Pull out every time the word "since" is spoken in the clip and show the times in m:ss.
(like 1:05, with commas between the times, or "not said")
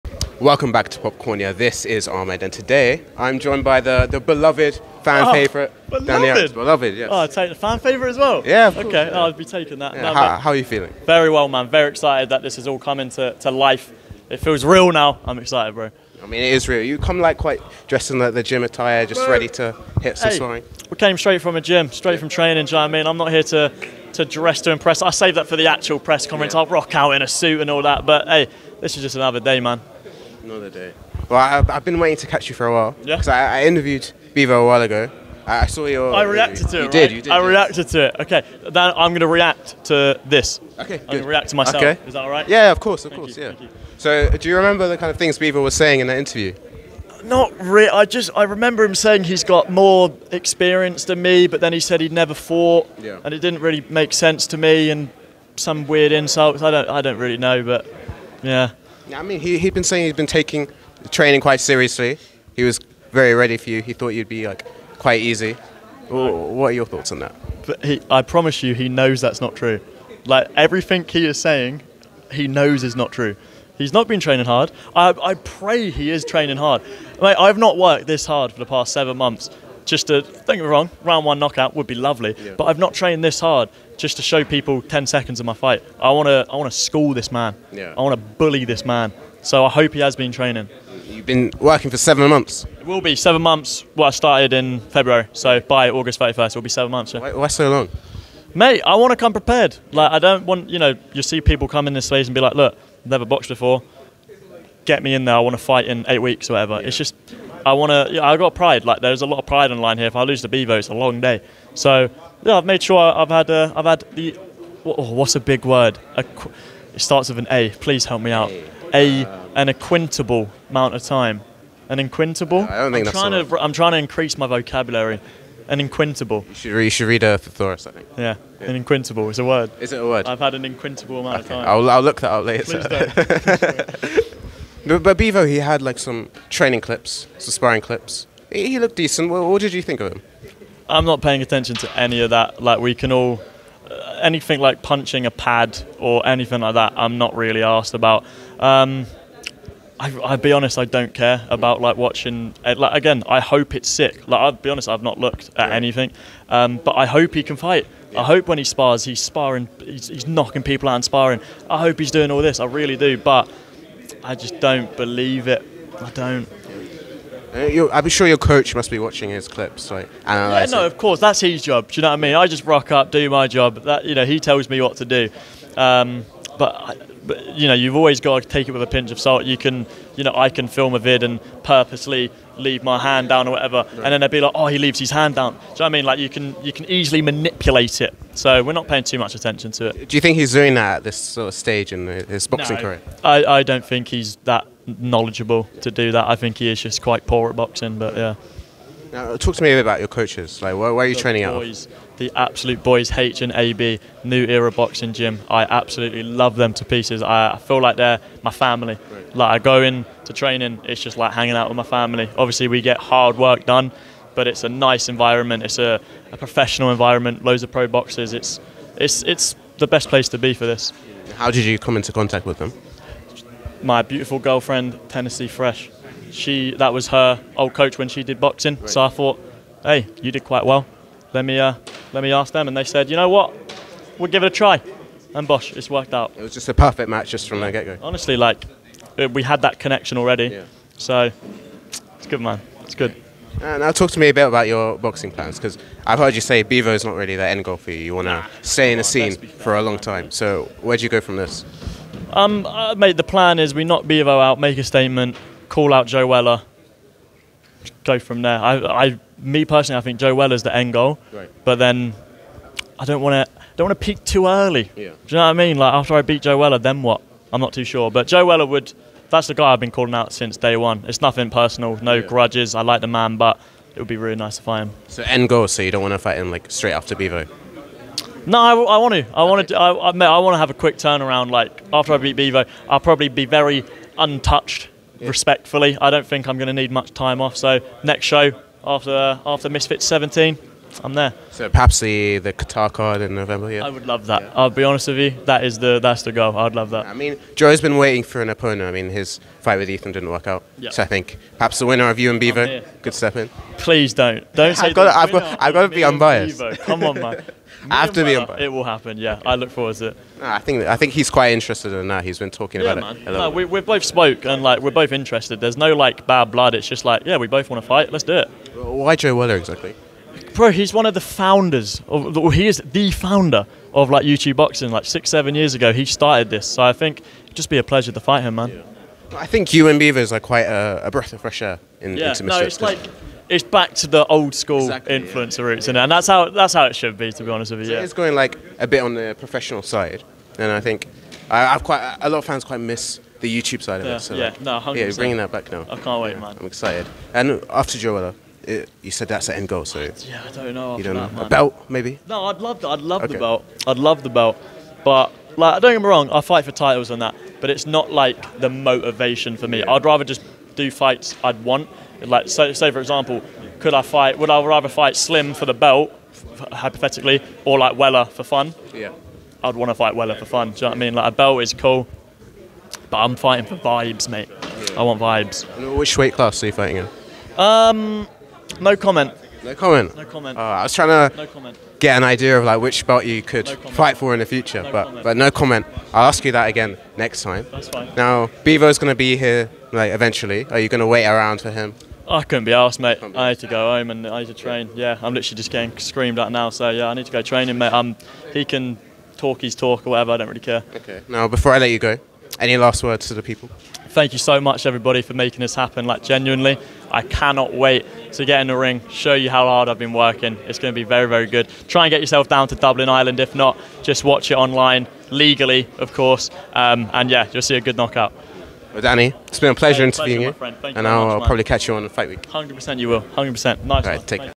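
4:30.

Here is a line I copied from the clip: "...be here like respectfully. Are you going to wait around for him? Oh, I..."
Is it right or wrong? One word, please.
wrong.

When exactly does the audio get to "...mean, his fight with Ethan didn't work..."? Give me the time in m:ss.
4:58.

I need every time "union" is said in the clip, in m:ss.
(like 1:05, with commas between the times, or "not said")
not said.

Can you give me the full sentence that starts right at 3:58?
Honestly, like we had that connection already.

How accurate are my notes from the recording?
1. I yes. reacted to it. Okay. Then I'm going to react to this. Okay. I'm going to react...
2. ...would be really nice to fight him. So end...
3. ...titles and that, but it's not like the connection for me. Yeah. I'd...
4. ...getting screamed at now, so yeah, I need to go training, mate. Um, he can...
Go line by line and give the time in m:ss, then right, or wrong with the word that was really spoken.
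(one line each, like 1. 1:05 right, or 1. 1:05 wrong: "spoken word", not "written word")
1. 0:37 right
2. 4:33 right
3. 5:56 wrong: "motivation", not "connection"
4. 6:35 right.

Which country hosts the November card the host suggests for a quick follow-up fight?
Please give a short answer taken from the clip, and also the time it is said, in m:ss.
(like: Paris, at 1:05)
Qatar, at 4:52.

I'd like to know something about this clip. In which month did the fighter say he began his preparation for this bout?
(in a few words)
February.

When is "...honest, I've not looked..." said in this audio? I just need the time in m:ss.
2:34.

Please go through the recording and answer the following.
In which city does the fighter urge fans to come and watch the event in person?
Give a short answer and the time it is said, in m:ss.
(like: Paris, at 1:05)
Dublin, at 6:52.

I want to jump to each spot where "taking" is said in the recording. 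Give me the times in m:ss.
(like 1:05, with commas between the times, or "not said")
0:09, 1:00.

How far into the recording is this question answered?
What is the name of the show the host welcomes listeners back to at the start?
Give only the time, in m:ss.
0:00.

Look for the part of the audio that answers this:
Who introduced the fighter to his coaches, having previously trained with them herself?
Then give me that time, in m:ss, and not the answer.
3:45.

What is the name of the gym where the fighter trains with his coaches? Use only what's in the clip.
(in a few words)
New Era Boxing Gym.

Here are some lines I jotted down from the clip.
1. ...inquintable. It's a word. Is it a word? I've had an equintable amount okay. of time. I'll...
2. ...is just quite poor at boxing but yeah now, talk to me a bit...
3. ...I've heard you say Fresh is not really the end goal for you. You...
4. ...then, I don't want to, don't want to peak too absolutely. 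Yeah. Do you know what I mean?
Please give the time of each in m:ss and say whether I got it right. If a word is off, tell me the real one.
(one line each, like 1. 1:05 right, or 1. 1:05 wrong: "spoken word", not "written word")
1. 2:08 wrong: "inquintable", not "equintable"
2. 3:16 right
3. 4:06 wrong: "Beavo", not "Fresh"
4. 4:21 wrong: "early", not "absolutely".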